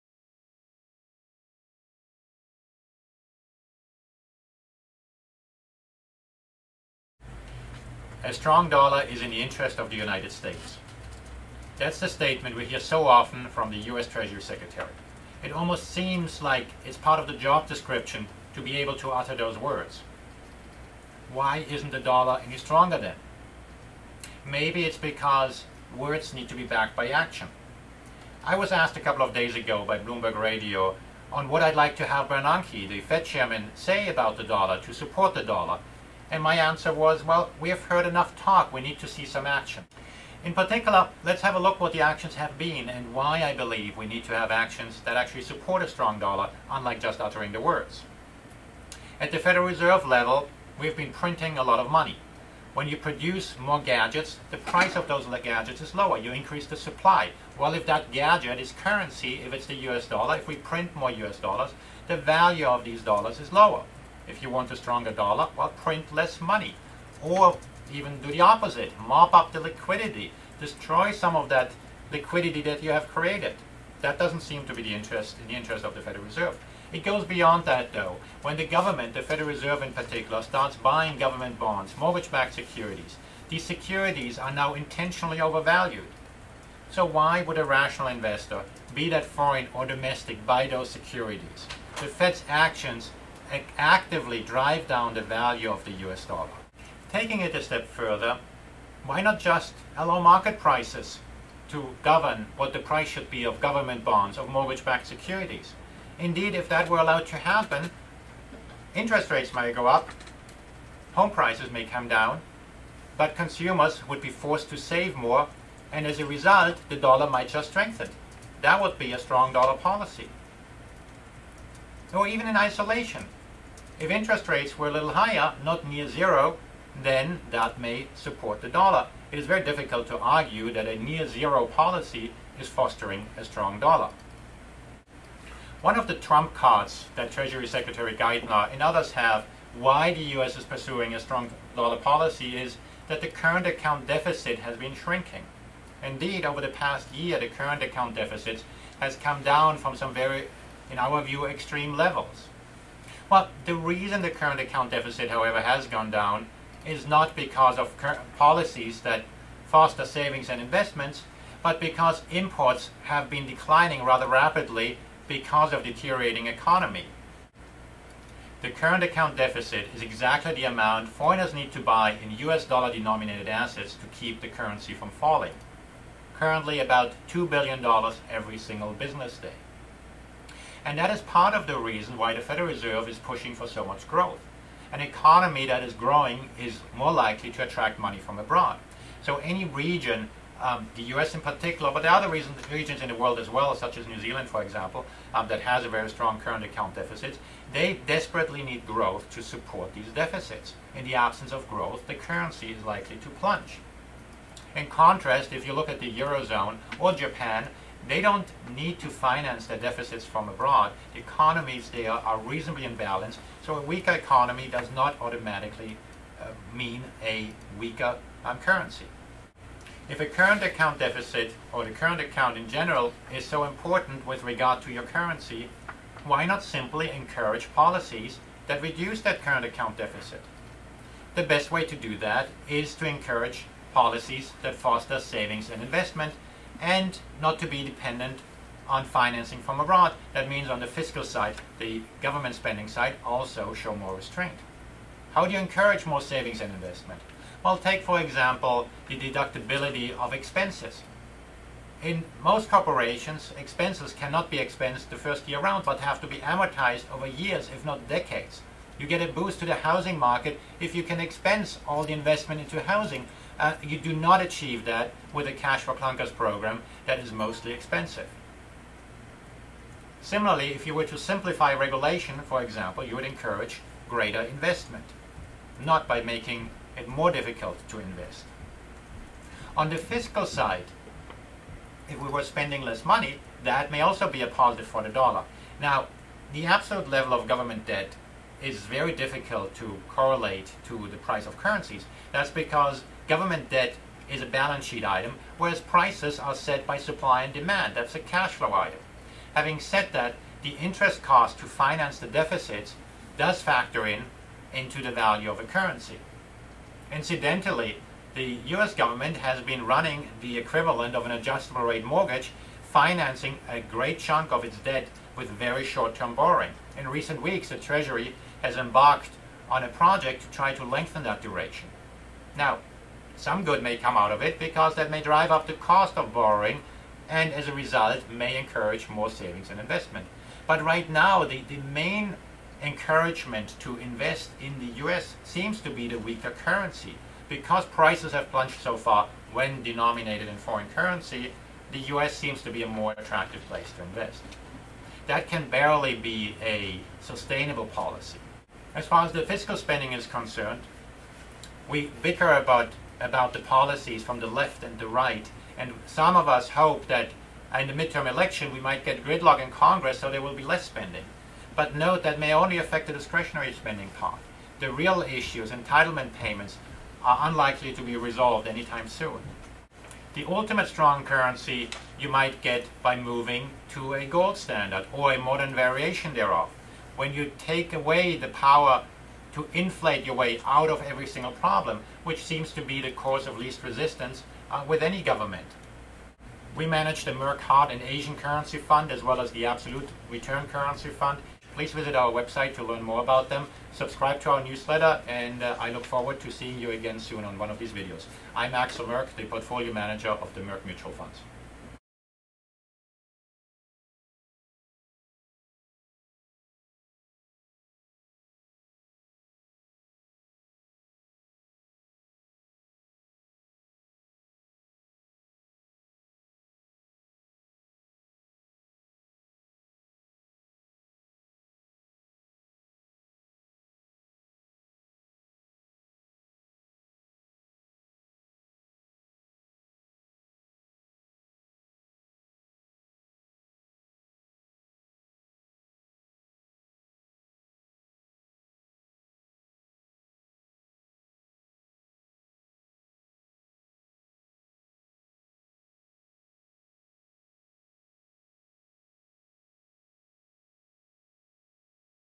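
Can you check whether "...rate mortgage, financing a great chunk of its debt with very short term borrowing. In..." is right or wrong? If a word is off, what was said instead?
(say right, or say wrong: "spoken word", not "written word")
right.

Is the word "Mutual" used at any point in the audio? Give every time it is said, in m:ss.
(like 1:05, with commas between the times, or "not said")
6:40.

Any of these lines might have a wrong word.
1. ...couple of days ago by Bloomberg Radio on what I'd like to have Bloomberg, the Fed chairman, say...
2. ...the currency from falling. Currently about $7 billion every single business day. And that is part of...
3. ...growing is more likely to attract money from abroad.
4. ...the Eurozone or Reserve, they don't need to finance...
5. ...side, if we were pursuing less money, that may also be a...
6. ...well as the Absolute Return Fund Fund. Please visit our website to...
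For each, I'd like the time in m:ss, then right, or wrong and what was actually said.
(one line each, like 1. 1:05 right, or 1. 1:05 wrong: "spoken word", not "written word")
1. 0:29 wrong: "Bernanke", not "Bloomberg"
2. 2:54 wrong: "2", not "7"
3. 3:05 right
4. 3:25 wrong: "Japan", not "Reserve"
5. 4:40 wrong: "spending", not "pursuing"
6. 6:29 wrong: "Currency", not "Fund".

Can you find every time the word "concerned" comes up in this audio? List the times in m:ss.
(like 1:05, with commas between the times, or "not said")
5:50.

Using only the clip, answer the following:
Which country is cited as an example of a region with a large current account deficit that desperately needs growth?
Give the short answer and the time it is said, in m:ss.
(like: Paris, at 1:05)
New Zealand, at 3:14.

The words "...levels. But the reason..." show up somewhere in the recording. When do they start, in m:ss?
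2:31.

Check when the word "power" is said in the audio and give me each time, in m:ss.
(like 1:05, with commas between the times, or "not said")
6:18.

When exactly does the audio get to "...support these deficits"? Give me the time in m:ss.
3:19.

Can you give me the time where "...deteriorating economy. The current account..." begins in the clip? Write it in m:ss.
2:45.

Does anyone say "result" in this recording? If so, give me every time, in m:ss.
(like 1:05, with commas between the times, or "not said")
1:56, 5:27.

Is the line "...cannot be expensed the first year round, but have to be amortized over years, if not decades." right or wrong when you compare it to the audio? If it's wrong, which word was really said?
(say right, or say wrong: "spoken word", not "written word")
right.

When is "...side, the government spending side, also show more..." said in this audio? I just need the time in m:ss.
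4:01.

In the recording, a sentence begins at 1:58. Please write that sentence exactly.
That would be a strong dollar policy.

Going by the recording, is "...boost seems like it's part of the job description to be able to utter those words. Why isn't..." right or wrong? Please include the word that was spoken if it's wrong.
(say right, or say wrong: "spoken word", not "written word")
wrong: "almost", not "boost".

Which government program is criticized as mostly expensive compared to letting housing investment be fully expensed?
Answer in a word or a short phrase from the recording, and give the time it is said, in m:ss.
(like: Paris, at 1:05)
cash for clunkers, at 4:25.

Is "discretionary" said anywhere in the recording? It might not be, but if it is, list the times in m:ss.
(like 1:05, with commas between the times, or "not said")
6:03.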